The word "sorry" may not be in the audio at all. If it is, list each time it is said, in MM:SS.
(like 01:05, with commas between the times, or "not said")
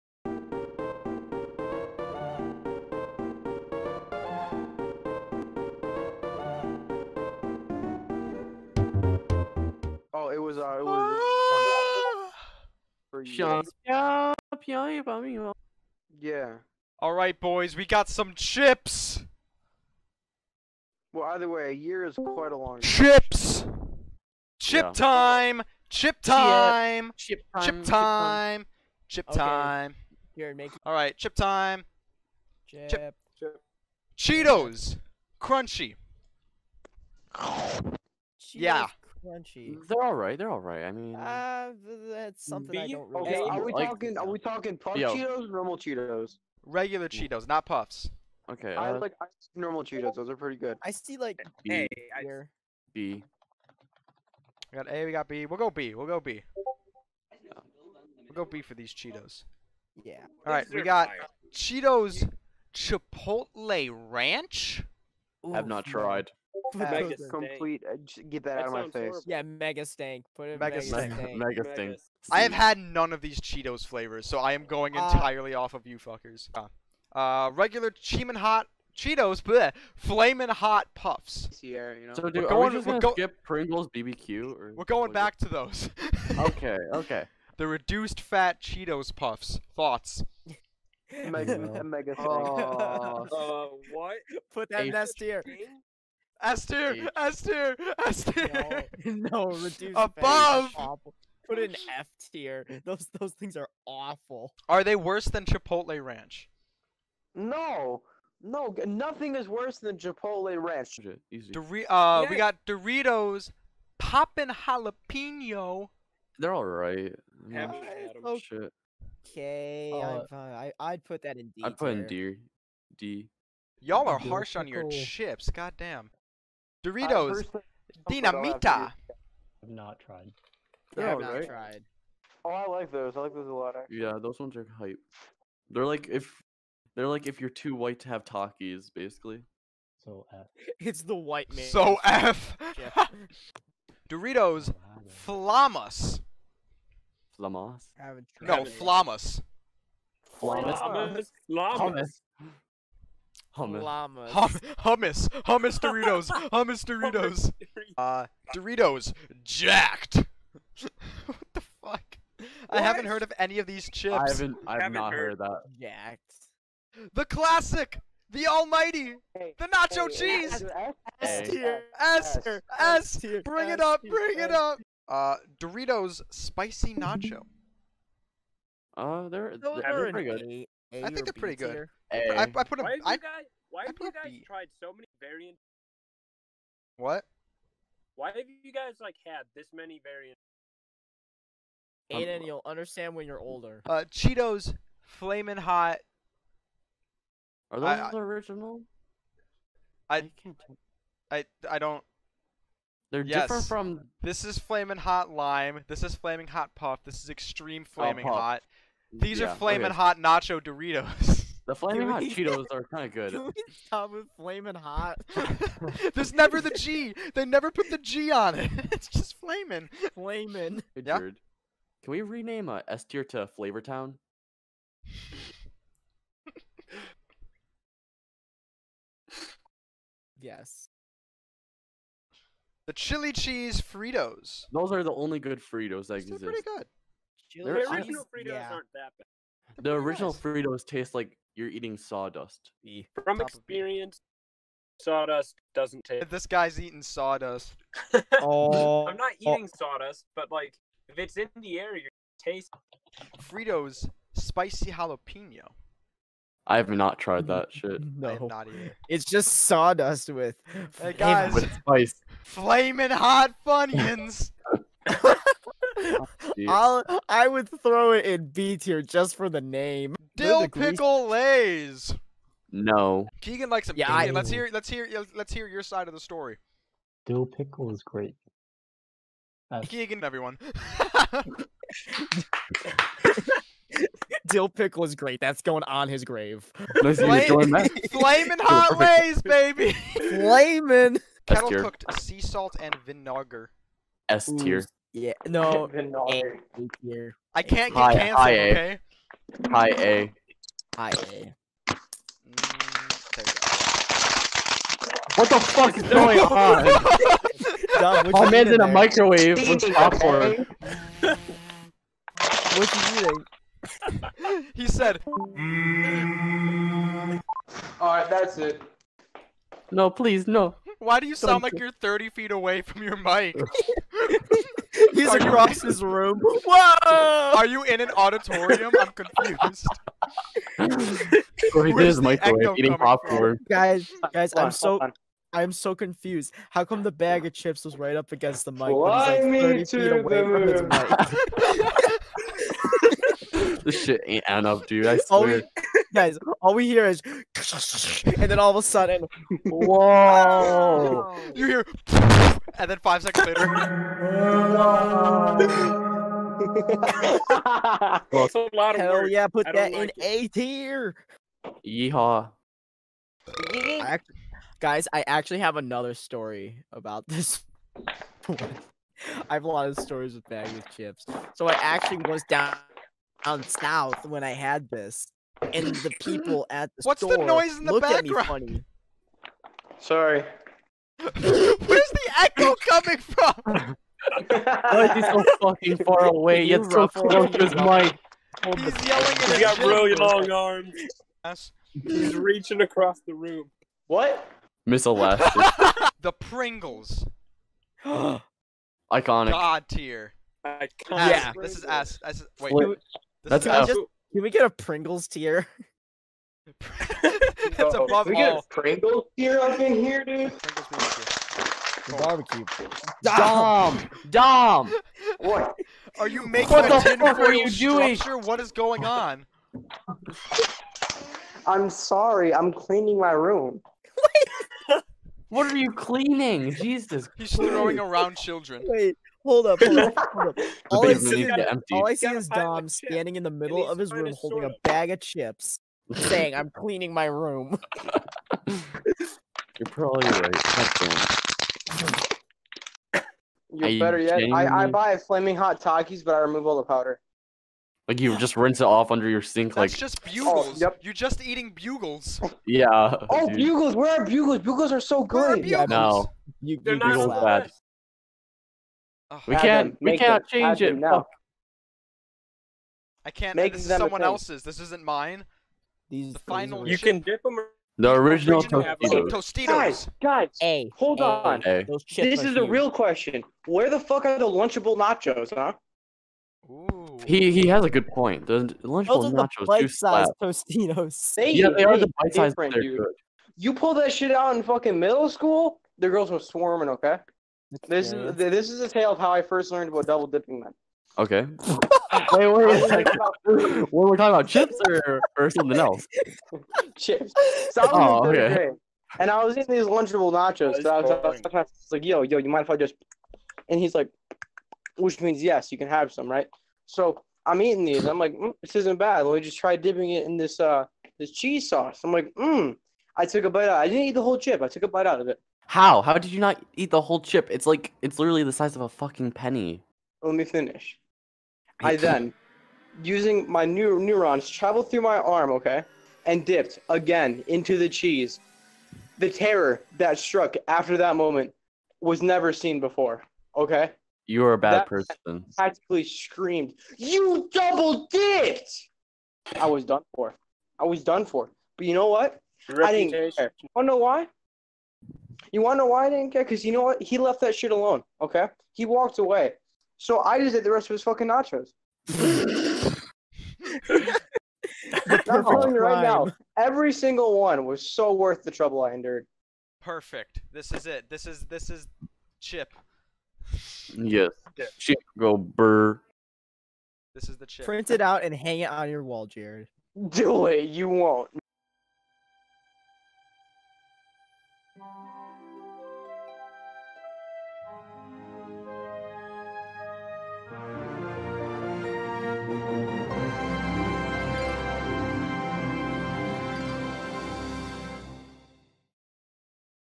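06:19, 07:01.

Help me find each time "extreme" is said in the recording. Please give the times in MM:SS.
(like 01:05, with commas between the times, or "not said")
03:27.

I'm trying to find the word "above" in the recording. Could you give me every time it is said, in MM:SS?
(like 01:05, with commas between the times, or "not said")
01:39, 06:47.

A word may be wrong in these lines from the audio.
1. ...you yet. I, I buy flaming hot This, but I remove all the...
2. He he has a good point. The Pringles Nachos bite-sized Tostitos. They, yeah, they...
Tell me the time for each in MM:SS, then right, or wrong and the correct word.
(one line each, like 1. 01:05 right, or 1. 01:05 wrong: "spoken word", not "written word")
1. 07:24 wrong: "Takis", not "This"
2. 07:57 wrong: "Lunchable", not "Pringles".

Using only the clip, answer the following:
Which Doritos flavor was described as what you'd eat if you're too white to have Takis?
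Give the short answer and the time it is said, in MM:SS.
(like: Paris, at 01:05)
Dinamita, at 02:08.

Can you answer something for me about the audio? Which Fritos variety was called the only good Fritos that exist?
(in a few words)
chili cheese.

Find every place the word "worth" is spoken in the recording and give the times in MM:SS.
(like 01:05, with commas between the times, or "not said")
09:18.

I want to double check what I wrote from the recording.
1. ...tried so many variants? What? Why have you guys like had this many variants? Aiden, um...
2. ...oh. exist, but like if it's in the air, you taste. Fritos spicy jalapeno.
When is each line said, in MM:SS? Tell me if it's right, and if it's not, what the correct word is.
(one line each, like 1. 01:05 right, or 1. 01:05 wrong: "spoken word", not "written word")
1. 03:04 right
2. 04:09 wrong: "sawdust", not "exist".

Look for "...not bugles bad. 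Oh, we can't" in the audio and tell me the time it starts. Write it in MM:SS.
07:36.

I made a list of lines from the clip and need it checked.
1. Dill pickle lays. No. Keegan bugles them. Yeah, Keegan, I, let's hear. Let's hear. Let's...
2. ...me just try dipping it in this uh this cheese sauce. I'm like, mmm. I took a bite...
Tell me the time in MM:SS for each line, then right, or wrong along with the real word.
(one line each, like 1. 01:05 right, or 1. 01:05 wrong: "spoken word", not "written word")
1. 04:30 wrong: "likes", not "bugles"
2. 08:29 right.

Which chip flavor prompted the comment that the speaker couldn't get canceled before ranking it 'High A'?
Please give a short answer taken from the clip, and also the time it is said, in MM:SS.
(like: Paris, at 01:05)
sea salt and vinegar, at 04:51.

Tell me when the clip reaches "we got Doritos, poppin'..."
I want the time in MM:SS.
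01:52.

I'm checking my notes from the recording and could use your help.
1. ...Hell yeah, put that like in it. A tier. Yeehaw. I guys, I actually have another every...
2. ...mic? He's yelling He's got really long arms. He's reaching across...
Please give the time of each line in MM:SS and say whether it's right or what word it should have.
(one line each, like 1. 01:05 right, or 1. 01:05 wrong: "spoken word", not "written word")
1. 05:59 wrong: "story", not "every"
2. 06:27 right.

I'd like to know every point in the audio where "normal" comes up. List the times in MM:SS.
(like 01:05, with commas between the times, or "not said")
00:45, 00:49.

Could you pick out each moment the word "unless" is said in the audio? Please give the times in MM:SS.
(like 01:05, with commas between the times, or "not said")
not said.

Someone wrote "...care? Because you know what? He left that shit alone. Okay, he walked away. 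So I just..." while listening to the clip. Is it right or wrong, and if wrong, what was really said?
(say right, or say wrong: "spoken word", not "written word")
right.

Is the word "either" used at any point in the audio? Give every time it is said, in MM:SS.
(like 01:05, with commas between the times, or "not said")
00:21, 04:18.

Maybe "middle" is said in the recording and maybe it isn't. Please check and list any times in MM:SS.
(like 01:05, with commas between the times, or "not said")
07:13, 08:04.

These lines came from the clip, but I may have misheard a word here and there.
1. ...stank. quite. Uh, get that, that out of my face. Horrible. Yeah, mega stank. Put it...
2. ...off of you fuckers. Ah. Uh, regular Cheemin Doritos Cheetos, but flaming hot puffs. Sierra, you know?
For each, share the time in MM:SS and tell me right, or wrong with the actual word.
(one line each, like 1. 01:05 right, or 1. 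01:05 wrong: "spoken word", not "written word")
1. 01:07 wrong: "complete", not "quite"
2. 01:15 wrong: "Hot", not "Doritos".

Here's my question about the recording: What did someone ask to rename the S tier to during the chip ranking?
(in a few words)
Flavor Town.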